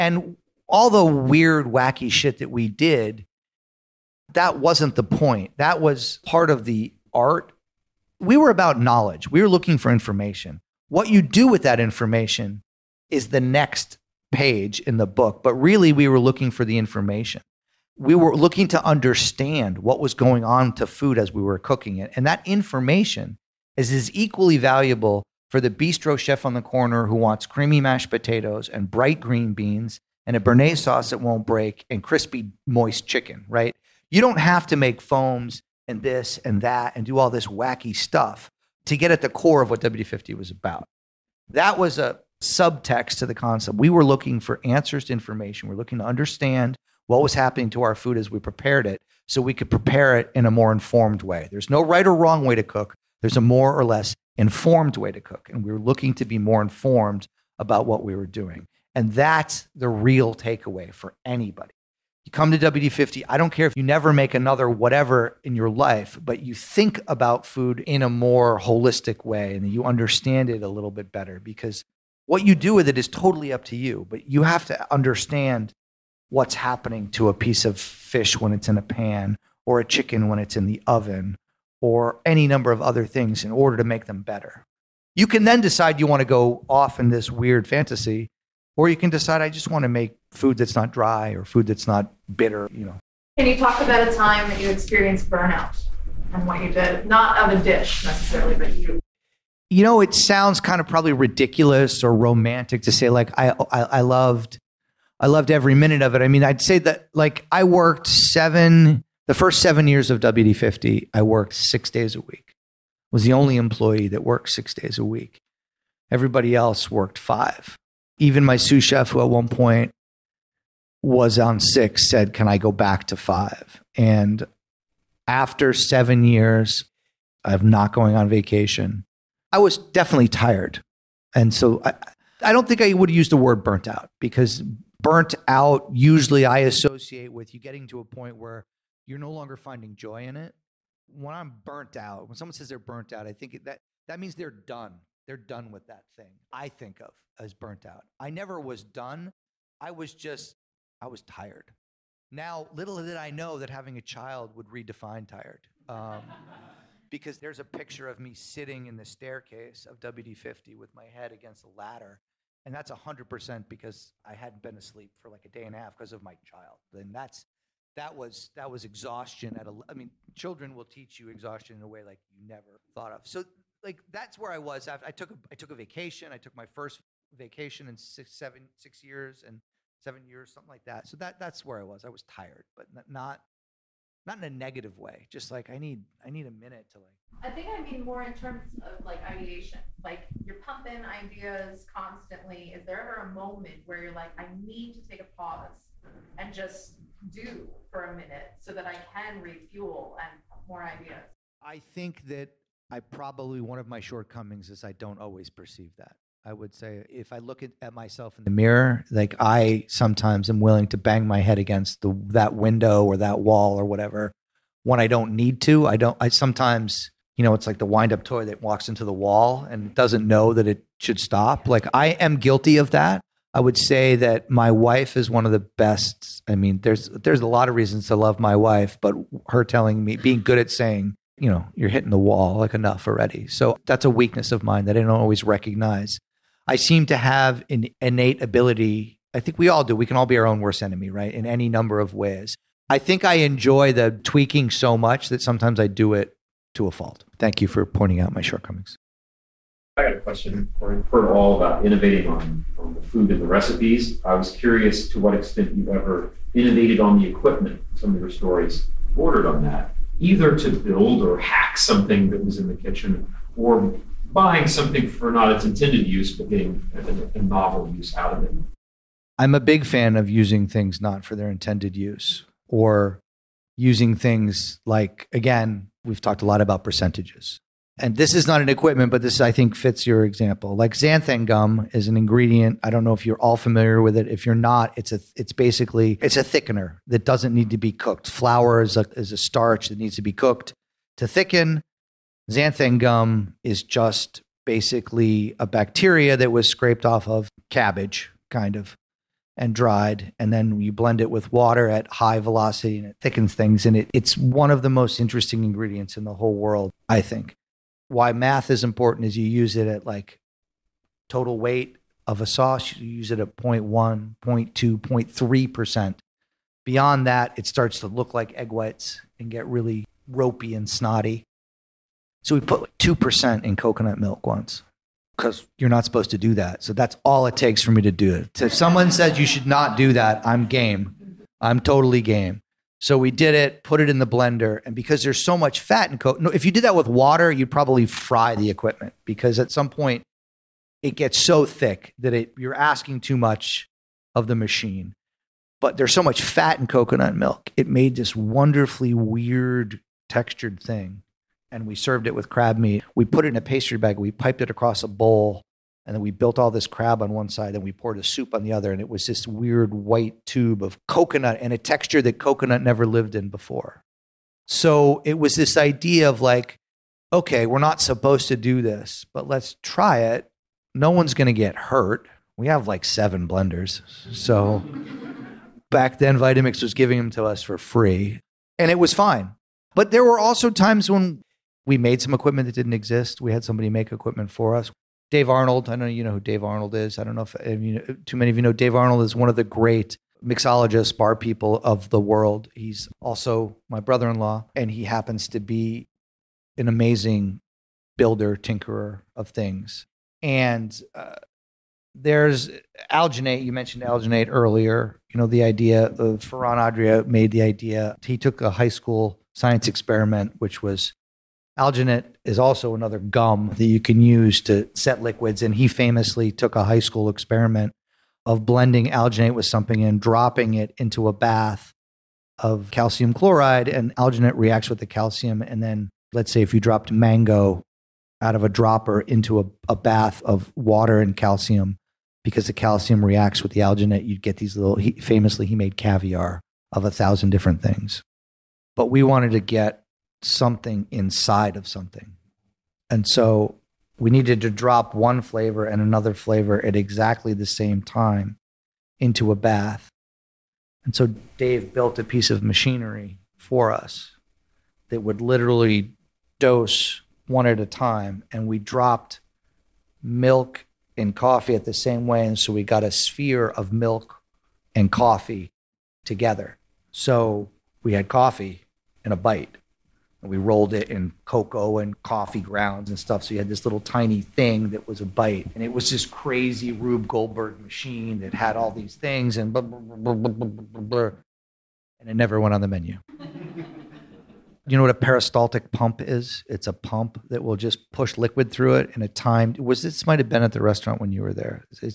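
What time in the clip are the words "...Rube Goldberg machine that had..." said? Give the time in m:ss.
7:56.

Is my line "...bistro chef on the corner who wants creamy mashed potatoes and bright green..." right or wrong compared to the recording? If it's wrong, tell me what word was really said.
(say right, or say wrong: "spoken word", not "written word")
right.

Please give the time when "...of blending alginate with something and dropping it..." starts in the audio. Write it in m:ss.
6:58.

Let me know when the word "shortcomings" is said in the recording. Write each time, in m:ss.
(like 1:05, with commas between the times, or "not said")
3:23, 4:08.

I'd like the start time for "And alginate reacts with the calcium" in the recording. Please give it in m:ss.
7:03.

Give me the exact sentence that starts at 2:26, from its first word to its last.
I think of as burnt out.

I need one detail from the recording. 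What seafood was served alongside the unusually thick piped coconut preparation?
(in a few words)
crab meat.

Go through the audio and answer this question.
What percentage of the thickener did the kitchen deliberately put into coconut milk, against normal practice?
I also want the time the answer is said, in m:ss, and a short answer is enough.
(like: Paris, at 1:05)
2%, at 5:22.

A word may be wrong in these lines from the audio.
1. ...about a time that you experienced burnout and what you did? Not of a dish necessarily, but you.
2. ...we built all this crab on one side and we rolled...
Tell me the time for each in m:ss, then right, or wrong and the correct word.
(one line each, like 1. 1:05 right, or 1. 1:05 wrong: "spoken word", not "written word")
1. 1:33 right
2. 5:56 wrong: "poured", not "rolled".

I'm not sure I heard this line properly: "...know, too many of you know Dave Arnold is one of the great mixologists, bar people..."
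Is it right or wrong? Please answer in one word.
right.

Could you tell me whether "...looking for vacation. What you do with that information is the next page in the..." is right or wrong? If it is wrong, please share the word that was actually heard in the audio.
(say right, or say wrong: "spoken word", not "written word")
wrong: "information", not "vacation".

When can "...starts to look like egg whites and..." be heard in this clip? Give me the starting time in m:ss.
5:17.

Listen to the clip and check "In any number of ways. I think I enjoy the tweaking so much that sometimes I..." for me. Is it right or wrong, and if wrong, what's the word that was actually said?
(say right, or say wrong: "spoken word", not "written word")
right.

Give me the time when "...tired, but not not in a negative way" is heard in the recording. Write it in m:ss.
3:02.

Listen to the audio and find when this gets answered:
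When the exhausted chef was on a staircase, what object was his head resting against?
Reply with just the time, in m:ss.
2:41.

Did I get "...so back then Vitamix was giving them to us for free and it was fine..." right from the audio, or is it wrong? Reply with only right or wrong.
right.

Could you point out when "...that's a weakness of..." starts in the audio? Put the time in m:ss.
3:53.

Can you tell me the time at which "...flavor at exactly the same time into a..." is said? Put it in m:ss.
7:26.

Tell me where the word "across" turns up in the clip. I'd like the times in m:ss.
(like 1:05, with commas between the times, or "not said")
5:54.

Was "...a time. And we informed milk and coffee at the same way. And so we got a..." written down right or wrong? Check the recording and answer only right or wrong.
wrong.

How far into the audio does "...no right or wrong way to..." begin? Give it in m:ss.
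0:51.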